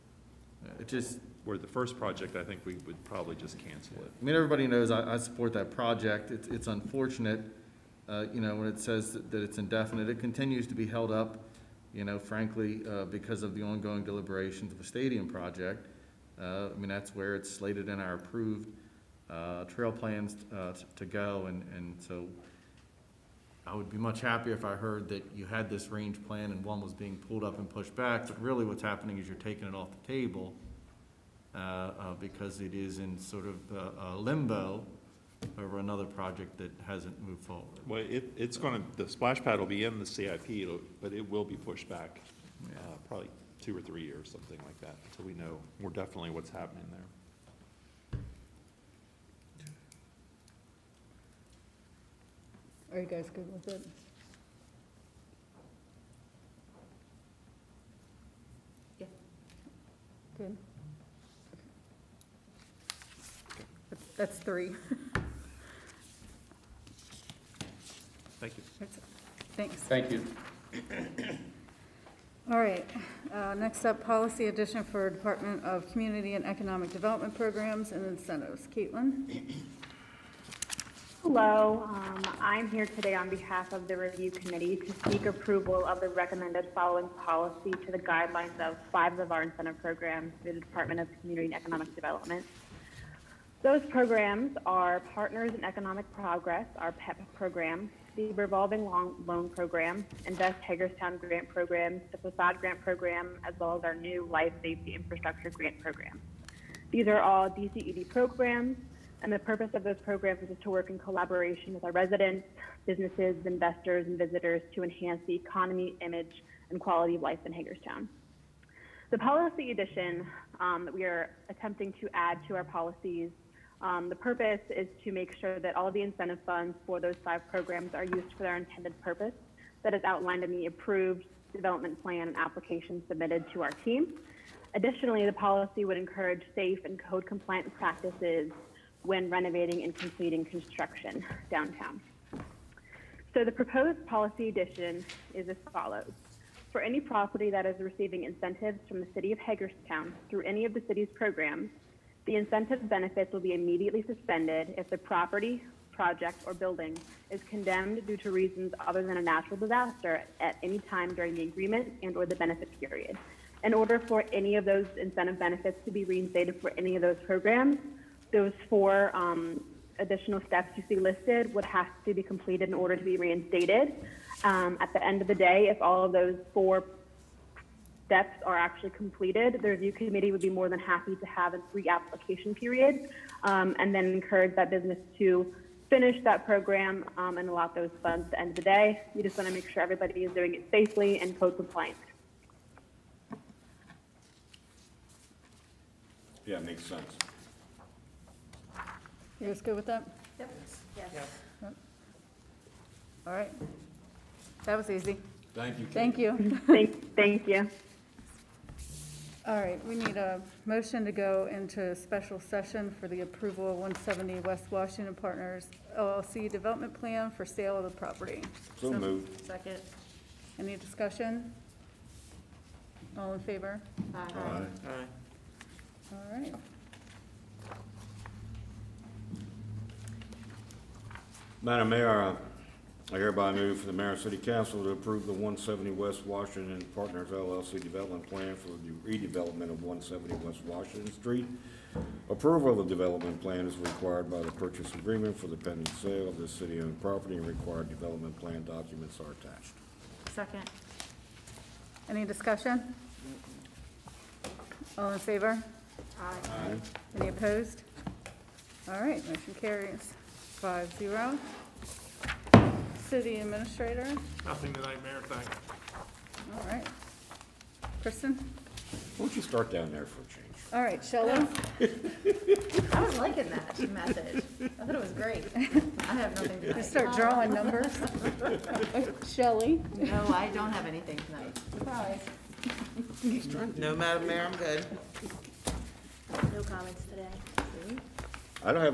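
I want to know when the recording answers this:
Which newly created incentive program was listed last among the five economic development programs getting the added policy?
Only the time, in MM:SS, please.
01:44.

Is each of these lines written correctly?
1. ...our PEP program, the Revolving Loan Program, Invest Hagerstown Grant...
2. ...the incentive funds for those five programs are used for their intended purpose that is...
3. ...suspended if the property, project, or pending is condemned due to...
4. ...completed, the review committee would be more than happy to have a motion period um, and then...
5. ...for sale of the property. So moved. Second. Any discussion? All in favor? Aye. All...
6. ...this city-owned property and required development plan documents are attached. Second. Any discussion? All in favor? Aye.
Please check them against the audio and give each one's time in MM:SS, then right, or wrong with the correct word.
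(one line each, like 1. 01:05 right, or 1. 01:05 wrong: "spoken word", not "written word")
1. 01:36 right
2. 02:05 right
3. 02:34 wrong: "building", not "pending"
4. 02:58 wrong: "reapplication", not "motion"
5. 03:37 right
6. 04:06 right.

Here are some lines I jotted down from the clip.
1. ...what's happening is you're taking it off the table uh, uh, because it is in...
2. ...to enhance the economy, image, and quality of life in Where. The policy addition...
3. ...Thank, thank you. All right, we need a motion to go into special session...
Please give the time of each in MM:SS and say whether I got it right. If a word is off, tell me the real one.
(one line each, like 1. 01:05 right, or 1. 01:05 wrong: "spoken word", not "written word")
1. 00:28 right
2. 01:54 wrong: "Hagerstown", not "Where"
3. 03:26 right.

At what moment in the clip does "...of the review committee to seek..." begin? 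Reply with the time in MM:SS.
01:23.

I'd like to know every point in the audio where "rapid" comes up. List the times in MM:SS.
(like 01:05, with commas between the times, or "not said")
not said.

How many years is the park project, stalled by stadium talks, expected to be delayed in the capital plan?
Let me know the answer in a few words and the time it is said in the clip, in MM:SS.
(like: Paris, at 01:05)
2 or 3 years, at 00:43.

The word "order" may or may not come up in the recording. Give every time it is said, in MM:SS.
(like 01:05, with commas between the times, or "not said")
02:43, 02:52.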